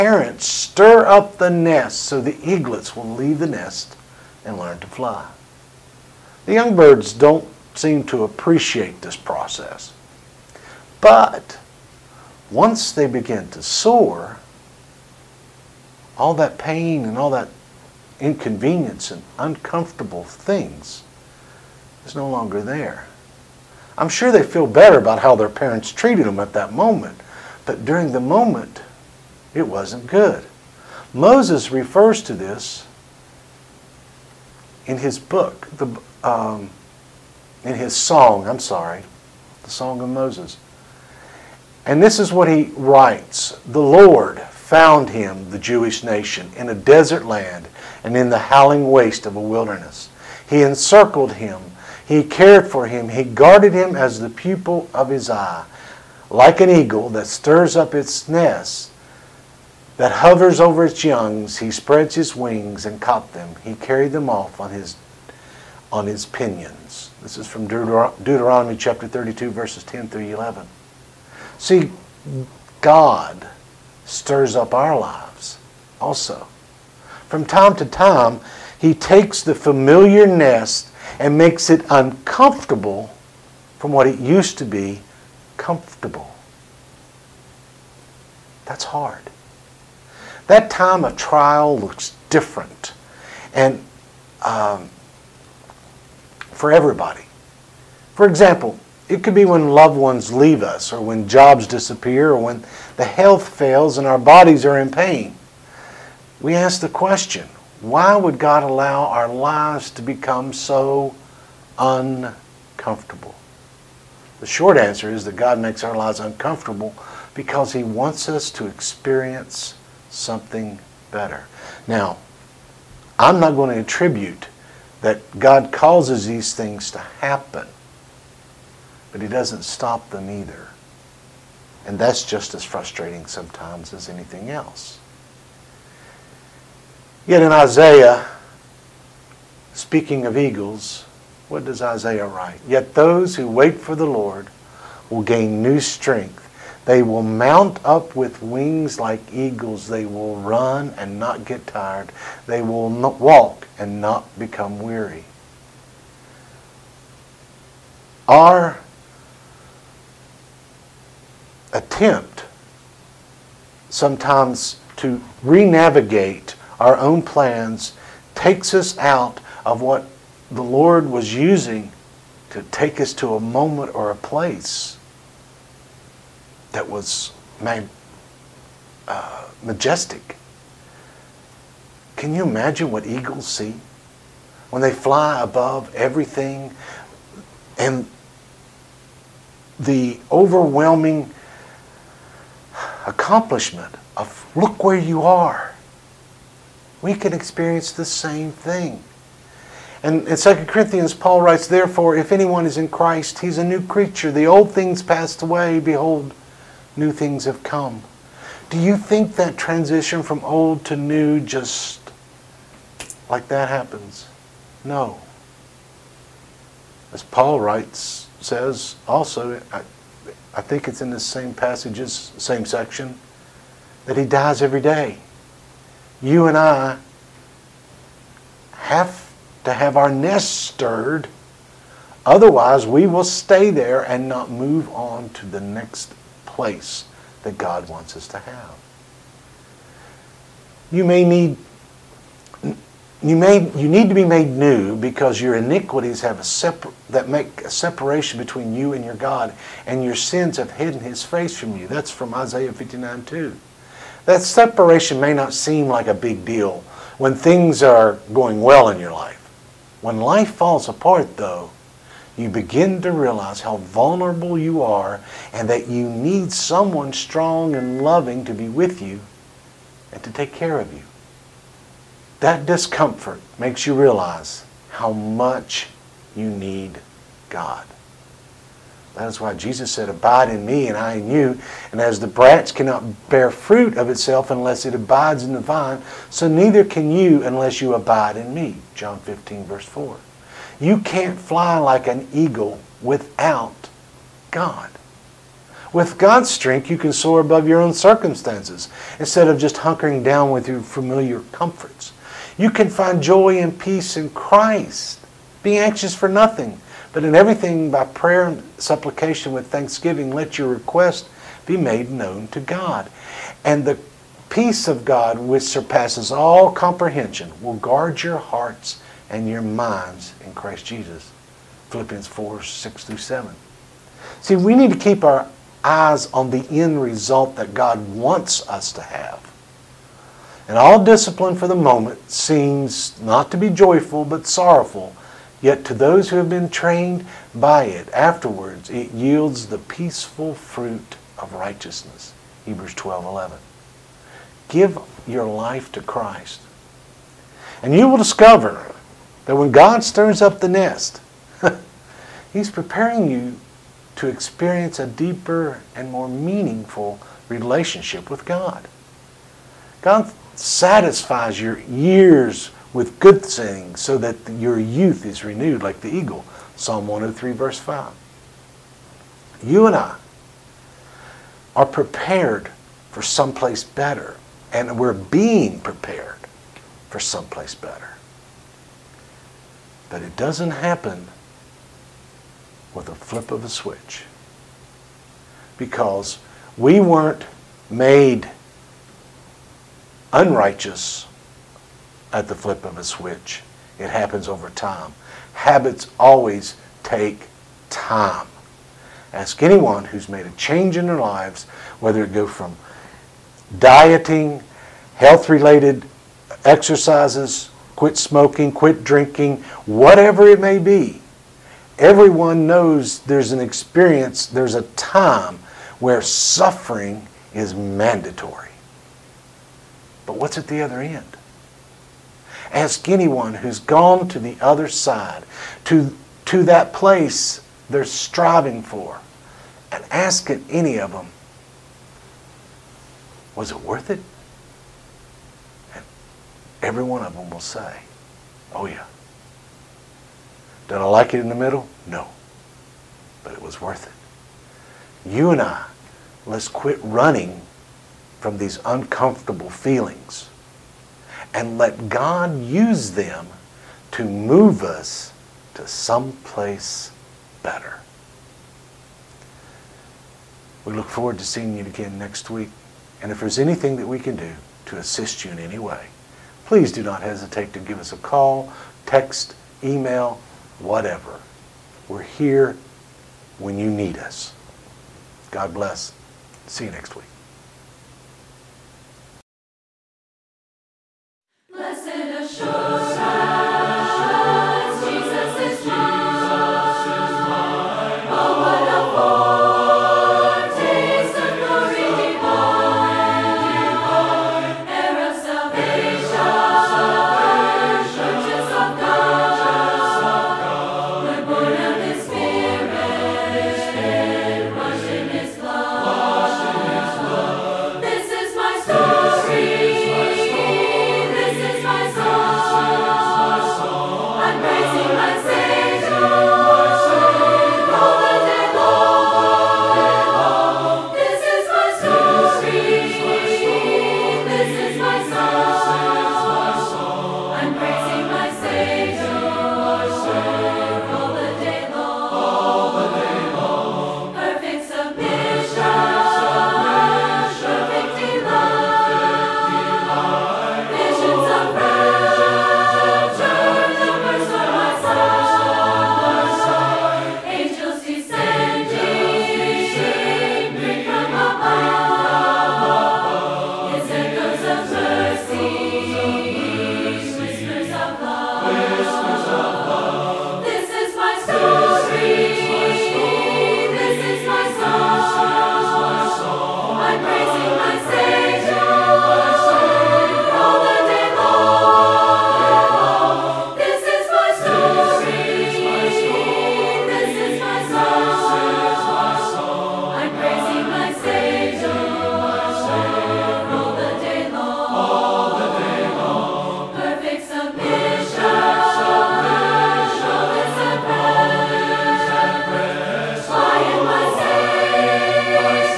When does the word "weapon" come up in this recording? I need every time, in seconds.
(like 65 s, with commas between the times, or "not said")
not said.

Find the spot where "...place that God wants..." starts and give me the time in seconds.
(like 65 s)
236 s.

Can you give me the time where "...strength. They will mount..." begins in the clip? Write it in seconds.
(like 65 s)
145 s.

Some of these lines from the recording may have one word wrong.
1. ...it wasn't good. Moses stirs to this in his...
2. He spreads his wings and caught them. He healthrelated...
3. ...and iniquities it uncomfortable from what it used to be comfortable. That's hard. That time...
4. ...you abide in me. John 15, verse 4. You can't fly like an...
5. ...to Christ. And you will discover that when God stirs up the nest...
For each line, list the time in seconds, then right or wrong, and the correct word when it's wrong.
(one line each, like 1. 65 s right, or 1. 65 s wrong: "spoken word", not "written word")
1. 29 s wrong: "refers", not "stirs"
2. 61 s wrong: "carried", not "healthrelated"
3. 81 s wrong: "makes", not "iniquities"
4. 287 s right
5. 345 s right.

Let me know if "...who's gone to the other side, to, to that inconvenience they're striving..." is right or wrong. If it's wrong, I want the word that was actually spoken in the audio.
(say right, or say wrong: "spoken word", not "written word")
wrong: "place", not "inconvenience".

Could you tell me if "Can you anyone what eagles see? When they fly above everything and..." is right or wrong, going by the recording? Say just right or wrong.
wrong.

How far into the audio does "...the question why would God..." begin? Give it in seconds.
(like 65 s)
106 s.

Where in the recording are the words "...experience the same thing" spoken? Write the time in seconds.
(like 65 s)
197 s.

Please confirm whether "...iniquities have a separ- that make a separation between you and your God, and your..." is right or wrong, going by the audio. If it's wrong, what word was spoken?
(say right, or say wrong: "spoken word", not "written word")
right.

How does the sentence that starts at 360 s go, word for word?
God satisfies your years with good things so that your youth is renewed like the eagle.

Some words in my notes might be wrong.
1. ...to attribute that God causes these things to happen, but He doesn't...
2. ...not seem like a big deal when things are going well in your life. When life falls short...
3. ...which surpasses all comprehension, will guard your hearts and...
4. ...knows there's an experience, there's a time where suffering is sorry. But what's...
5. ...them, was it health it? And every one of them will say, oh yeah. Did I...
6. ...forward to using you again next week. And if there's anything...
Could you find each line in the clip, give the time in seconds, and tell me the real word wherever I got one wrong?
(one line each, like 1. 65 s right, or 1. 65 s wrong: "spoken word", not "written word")
1. 123 s right
2. 255 s wrong: "apart", not "short"
3. 315 s right
4. 412 s wrong: "mandatory", not "sorry"
5. 431 s wrong: "worth", not "health"
6. 461 s wrong: "seeing", not "using".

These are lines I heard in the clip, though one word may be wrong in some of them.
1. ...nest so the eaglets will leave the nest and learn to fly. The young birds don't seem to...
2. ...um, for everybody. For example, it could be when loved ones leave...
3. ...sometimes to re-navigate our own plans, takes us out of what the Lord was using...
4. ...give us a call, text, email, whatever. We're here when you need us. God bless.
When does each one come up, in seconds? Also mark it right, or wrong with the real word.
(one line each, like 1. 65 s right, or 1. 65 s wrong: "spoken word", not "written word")
1. 1 s right
2. 94 s right
3. 163 s right
4. 467 s right.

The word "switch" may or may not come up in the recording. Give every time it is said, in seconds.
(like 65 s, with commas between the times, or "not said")
383 s, 393 s.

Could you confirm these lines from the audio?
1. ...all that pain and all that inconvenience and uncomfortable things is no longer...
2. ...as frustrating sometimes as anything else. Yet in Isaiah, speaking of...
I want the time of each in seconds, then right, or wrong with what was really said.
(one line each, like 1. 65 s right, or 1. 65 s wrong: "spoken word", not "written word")
1. 16 s right
2. 132 s right.